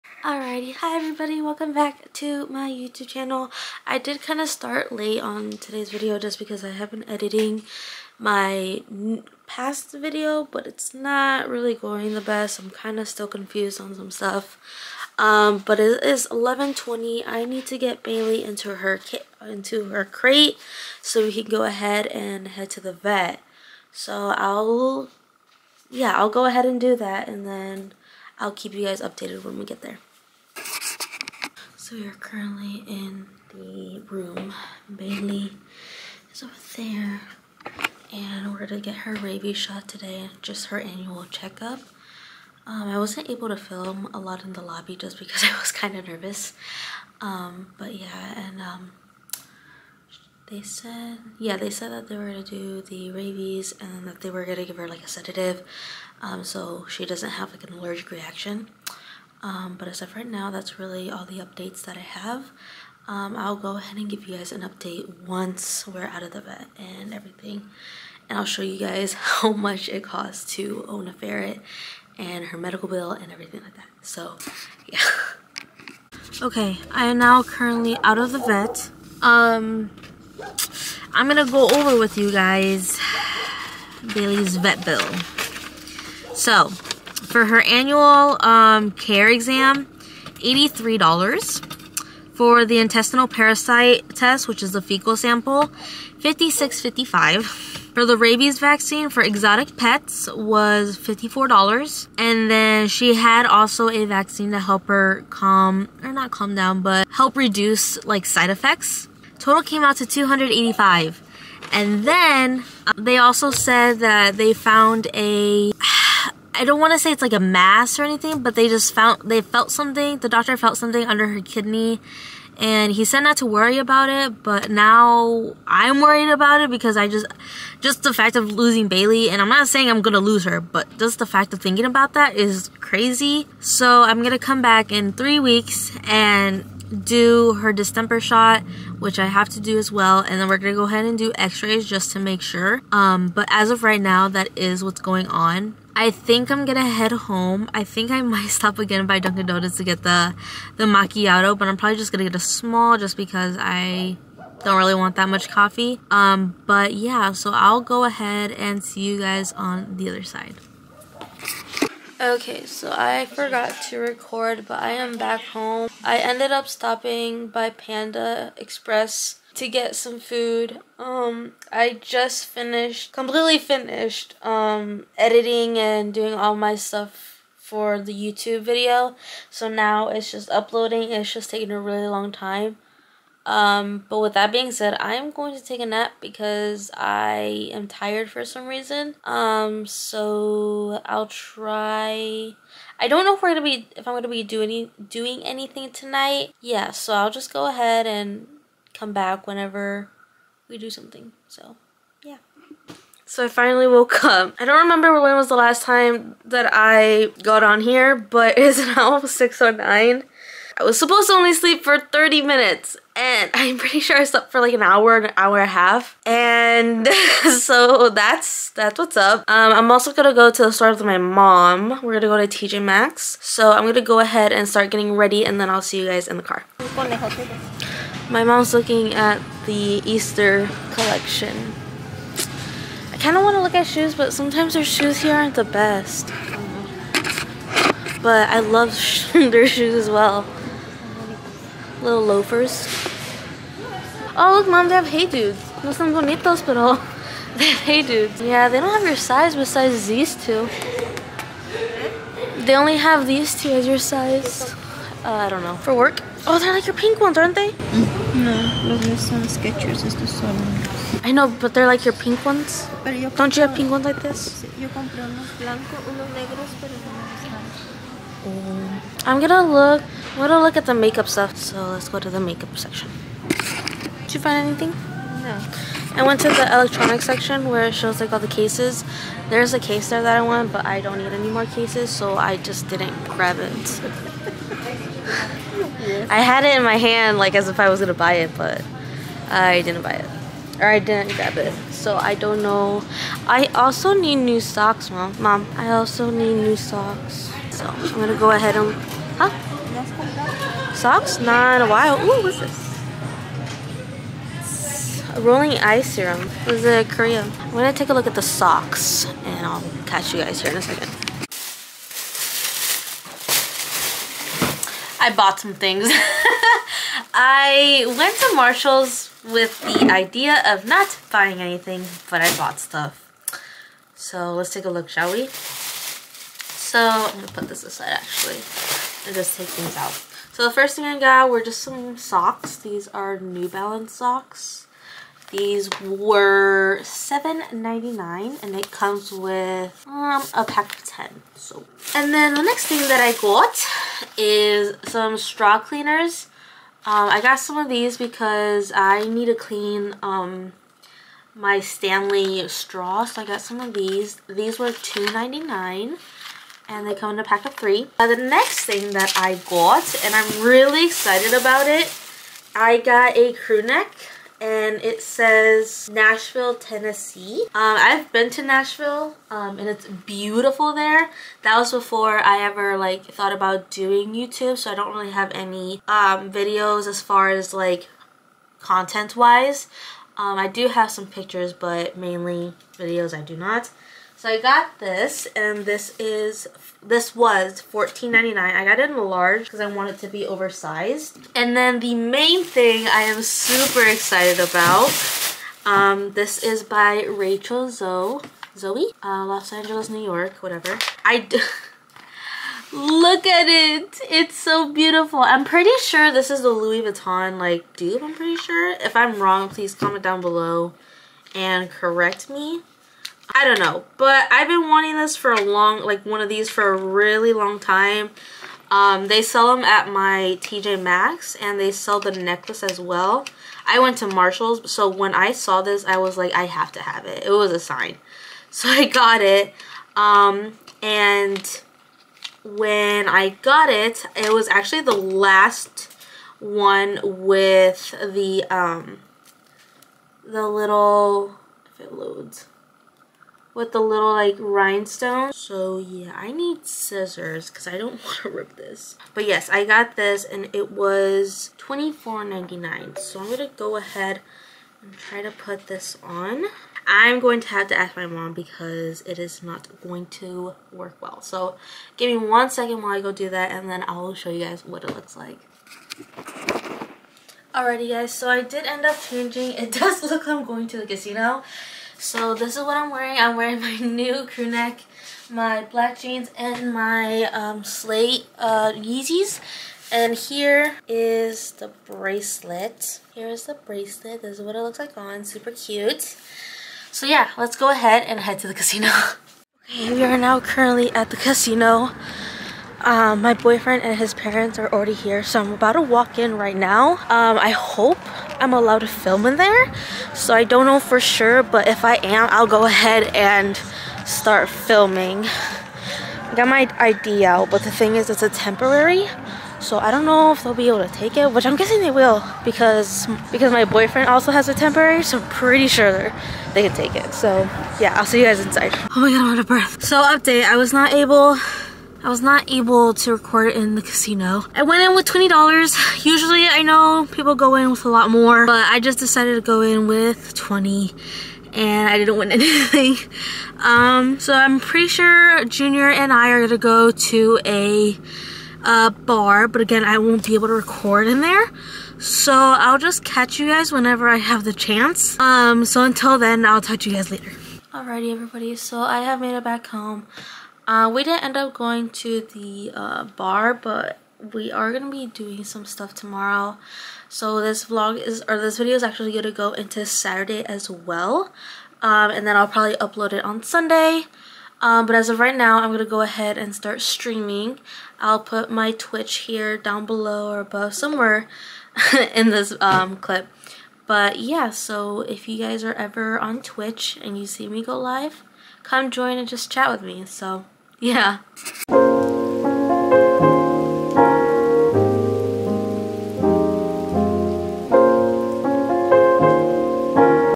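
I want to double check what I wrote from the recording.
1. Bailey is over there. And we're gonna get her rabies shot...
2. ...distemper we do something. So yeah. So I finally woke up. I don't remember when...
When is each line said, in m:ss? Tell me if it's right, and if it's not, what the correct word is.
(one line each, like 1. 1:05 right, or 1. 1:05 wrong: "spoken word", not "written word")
1. 0:34 right
2. 3:19 wrong: "whenever", not "distemper".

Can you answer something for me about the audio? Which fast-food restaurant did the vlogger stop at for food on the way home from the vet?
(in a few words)
Panda Express.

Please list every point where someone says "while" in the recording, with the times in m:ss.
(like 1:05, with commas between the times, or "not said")
5:01, 7:43.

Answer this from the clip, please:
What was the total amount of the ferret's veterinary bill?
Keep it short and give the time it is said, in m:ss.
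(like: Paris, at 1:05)
285, at 1:50.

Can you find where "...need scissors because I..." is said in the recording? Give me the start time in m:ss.
7:26.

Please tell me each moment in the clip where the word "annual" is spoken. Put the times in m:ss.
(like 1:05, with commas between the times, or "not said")
0:40, 1:27.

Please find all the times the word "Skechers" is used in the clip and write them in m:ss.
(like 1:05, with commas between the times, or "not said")
4:19.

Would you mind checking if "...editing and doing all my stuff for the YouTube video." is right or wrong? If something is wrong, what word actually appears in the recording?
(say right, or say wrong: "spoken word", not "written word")
right.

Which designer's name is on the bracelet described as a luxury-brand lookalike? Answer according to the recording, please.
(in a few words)
Rachel Zoe.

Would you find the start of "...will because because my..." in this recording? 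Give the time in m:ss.
8:32.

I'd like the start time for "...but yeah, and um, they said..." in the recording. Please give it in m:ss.
0:47.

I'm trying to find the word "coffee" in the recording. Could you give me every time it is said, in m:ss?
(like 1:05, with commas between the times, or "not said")
2:35.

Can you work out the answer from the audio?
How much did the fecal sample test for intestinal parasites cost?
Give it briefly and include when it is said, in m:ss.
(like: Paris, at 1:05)
$56.55, at 1:36.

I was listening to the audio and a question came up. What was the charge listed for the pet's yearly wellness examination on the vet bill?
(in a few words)
$83.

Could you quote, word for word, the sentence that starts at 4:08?
Yeah, they don't have your size besides these two.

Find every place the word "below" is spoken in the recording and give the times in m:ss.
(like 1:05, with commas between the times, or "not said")
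6:50, 9:30.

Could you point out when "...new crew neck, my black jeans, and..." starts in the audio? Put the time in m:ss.
7:53.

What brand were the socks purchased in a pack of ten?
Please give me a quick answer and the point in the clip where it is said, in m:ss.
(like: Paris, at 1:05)
New Balance, at 5:33.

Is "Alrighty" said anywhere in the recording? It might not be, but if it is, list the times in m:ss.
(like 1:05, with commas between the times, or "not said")
0:00, 7:47, 9:07.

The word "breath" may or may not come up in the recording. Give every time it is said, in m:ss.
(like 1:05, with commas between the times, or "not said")
8:39.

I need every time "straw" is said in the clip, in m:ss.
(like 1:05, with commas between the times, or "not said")
5:45, 5:52.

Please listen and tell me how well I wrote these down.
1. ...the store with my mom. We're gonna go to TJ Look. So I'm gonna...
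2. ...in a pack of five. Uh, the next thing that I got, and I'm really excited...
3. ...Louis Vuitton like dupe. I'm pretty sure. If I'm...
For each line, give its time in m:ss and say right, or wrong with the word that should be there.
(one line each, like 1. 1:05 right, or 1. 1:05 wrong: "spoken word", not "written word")
1. 3:40 wrong: "Maxx", not "Look"
2. 5:57 wrong: "three", not "five"
3. 6:46 right.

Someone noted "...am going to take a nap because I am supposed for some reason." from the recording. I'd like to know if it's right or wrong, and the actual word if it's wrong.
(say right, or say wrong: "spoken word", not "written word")
wrong: "tired", not "supposed".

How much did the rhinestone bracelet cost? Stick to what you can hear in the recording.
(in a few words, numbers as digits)
$24.99.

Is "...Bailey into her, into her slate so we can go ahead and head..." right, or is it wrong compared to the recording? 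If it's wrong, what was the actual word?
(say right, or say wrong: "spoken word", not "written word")
wrong: "crate", not "slate".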